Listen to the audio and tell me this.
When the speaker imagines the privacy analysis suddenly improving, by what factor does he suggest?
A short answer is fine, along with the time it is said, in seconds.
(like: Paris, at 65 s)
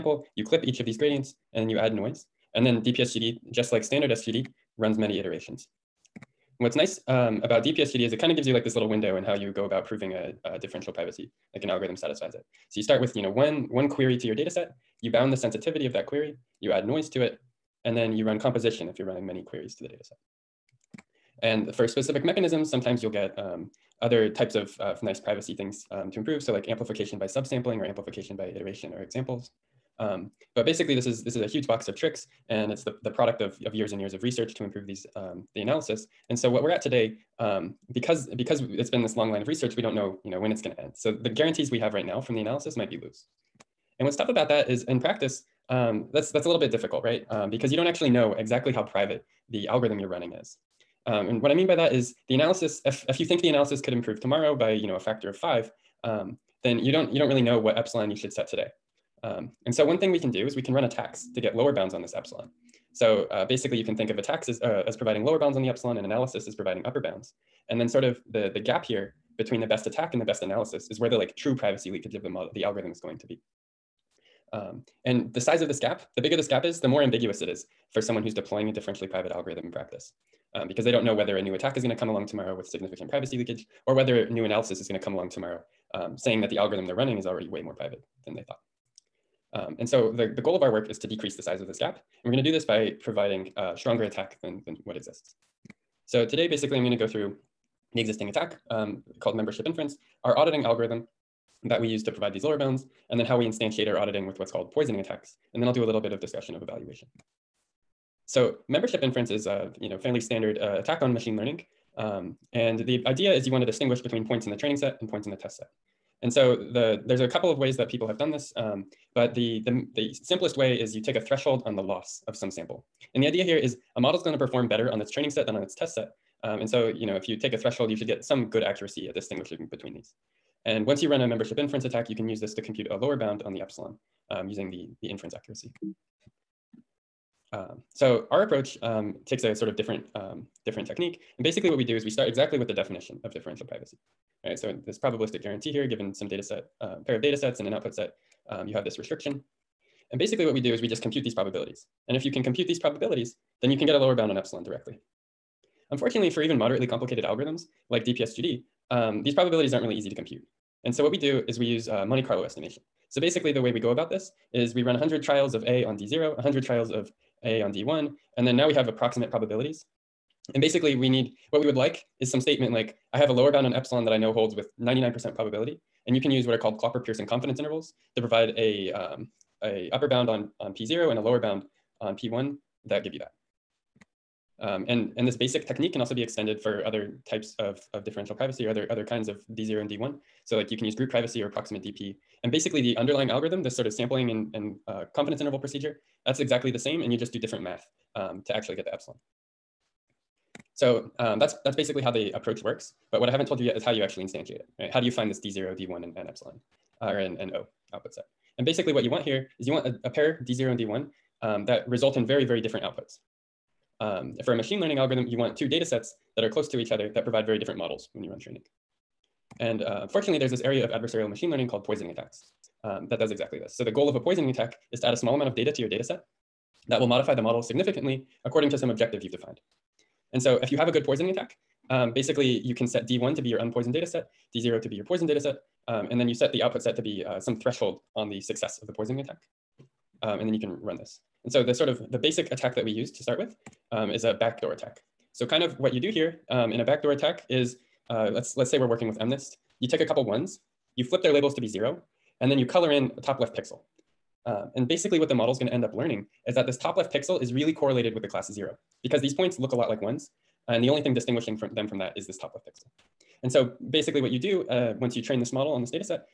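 five, at 54 s.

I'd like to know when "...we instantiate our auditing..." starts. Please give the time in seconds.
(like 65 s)
103 s.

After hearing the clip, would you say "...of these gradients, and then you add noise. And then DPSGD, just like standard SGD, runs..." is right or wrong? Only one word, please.
right.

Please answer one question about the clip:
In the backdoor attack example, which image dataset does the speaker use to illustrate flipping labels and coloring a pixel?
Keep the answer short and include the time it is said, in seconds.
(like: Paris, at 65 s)
MNIST, at 249 s.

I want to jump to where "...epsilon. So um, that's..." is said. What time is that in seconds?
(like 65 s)
198 s.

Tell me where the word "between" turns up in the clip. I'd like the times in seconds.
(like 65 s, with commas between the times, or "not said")
69 s, 113 s, 129 s.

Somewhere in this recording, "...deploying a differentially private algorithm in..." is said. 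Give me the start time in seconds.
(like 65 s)
78 s.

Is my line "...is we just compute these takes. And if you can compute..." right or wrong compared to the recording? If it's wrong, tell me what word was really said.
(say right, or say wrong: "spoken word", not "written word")
wrong: "probabilities", not "takes".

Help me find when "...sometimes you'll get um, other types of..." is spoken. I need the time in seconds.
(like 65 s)
22 s.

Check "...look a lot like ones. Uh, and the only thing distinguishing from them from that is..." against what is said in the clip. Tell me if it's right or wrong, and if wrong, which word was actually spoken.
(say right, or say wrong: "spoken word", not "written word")
right.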